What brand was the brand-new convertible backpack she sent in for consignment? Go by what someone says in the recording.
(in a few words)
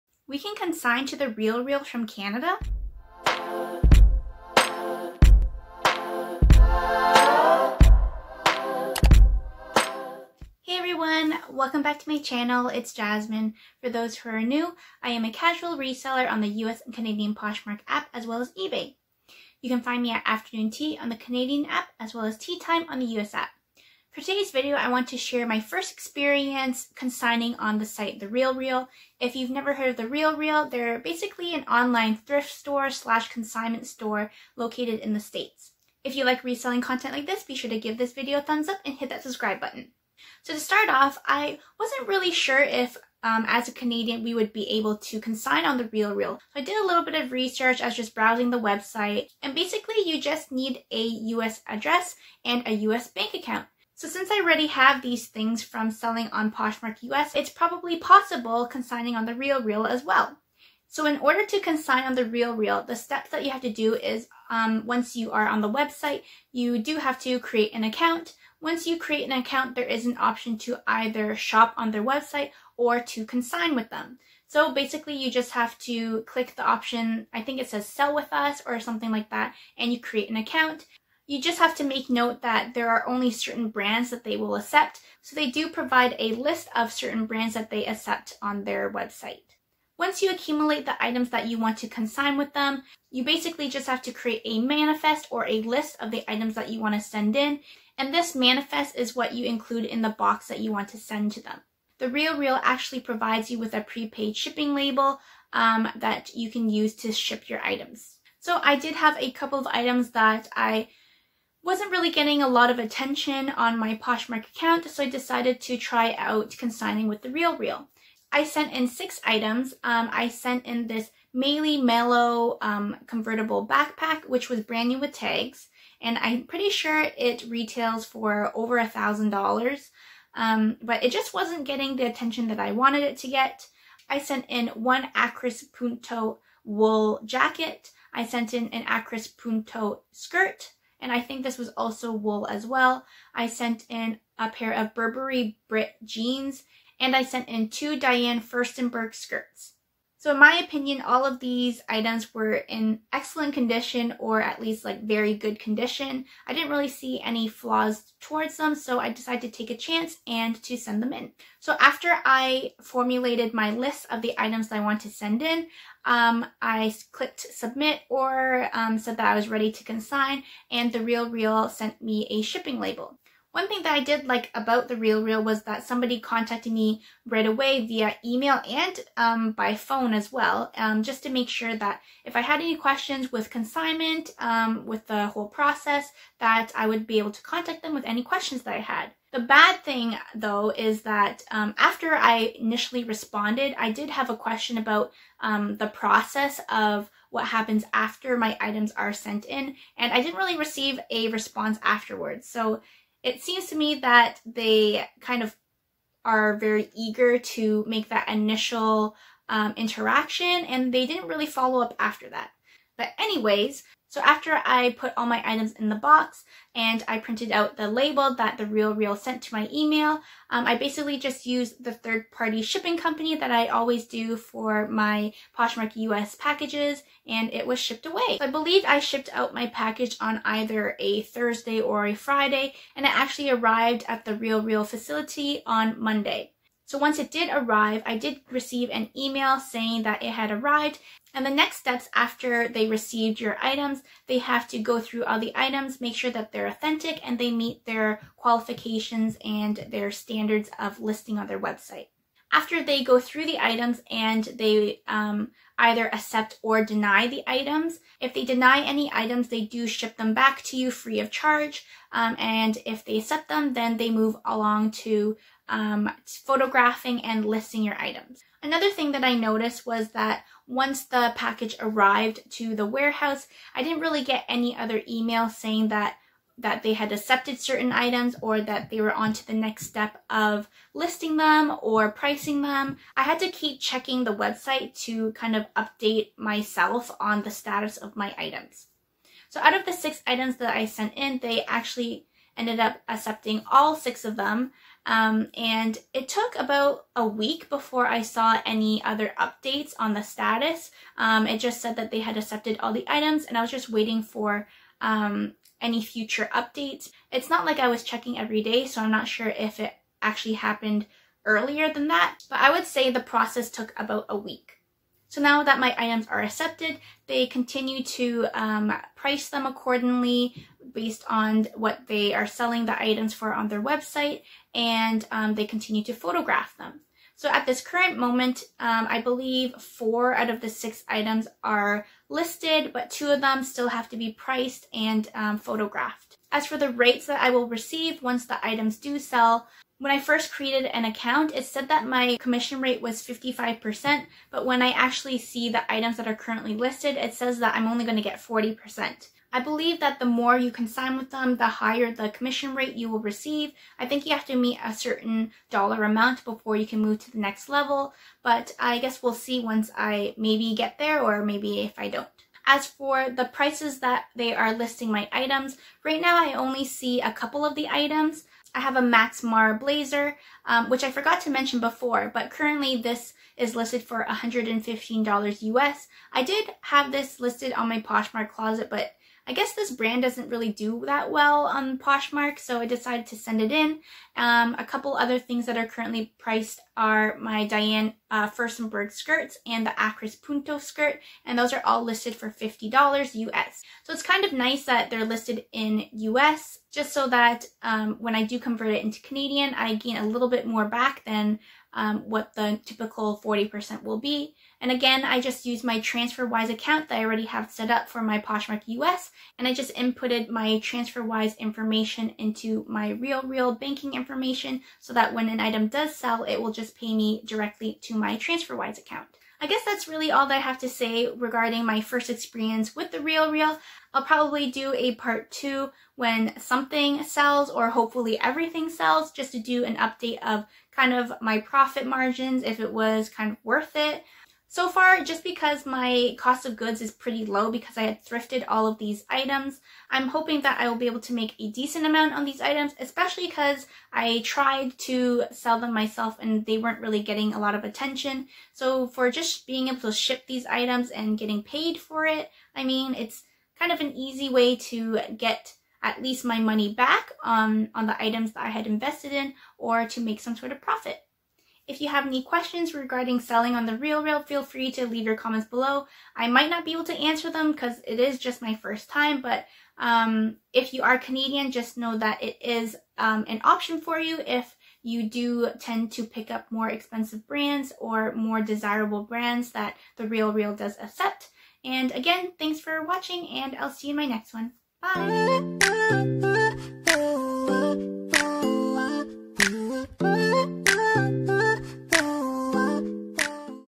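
Meli Melo.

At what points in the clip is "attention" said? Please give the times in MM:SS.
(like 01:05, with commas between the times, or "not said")
01:52, 02:12, 07:27.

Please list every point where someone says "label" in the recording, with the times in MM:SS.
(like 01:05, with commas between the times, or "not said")
01:44, 02:52, 03:37.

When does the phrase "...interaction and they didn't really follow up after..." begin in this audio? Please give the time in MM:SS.
03:29.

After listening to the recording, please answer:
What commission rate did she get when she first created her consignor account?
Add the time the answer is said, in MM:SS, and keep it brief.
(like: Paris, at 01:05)
55%, at 05:43.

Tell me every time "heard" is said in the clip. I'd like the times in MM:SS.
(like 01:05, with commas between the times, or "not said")
00:29.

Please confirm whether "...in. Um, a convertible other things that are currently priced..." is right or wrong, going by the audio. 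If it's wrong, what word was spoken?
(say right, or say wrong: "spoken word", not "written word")
wrong: "couple", not "convertible".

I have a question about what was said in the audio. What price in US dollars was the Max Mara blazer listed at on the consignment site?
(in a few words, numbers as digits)
$115.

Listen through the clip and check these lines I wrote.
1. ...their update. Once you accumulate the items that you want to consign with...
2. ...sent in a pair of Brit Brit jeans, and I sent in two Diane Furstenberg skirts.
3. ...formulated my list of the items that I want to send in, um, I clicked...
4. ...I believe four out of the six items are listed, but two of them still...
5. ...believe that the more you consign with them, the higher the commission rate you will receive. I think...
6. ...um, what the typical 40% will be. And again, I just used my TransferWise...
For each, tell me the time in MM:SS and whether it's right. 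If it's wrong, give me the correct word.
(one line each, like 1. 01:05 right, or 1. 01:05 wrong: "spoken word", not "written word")
1. 01:28 wrong: "website", not "update"
2. 02:23 wrong: "Burberry", not "Brit"
3. 02:42 right
4. 05:29 right
5. 05:49 right
6. 06:41 right.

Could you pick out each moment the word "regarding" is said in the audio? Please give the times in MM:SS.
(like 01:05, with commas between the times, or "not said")
07:01, 07:42.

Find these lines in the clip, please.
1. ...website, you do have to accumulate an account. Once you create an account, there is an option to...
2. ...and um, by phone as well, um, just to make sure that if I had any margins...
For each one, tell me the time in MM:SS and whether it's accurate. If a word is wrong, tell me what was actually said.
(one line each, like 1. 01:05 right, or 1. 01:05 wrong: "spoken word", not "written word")
1. 01:05 wrong: "create", not "accumulate"
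2. 02:58 wrong: "questions", not "margins".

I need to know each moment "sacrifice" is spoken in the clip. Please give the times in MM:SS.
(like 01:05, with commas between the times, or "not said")
not said.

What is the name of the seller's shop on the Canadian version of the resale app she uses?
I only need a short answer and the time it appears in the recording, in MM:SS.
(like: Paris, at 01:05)
Afternoon Tea, at 00:20.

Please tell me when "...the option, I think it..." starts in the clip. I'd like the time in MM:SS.
01:16.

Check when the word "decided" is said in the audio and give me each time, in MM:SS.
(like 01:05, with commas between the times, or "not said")
01:55, 02:39, 06:22.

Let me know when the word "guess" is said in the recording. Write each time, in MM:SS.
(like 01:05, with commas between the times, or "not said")
05:58, 06:19, 06:59.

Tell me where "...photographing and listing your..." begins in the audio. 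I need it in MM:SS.
04:26.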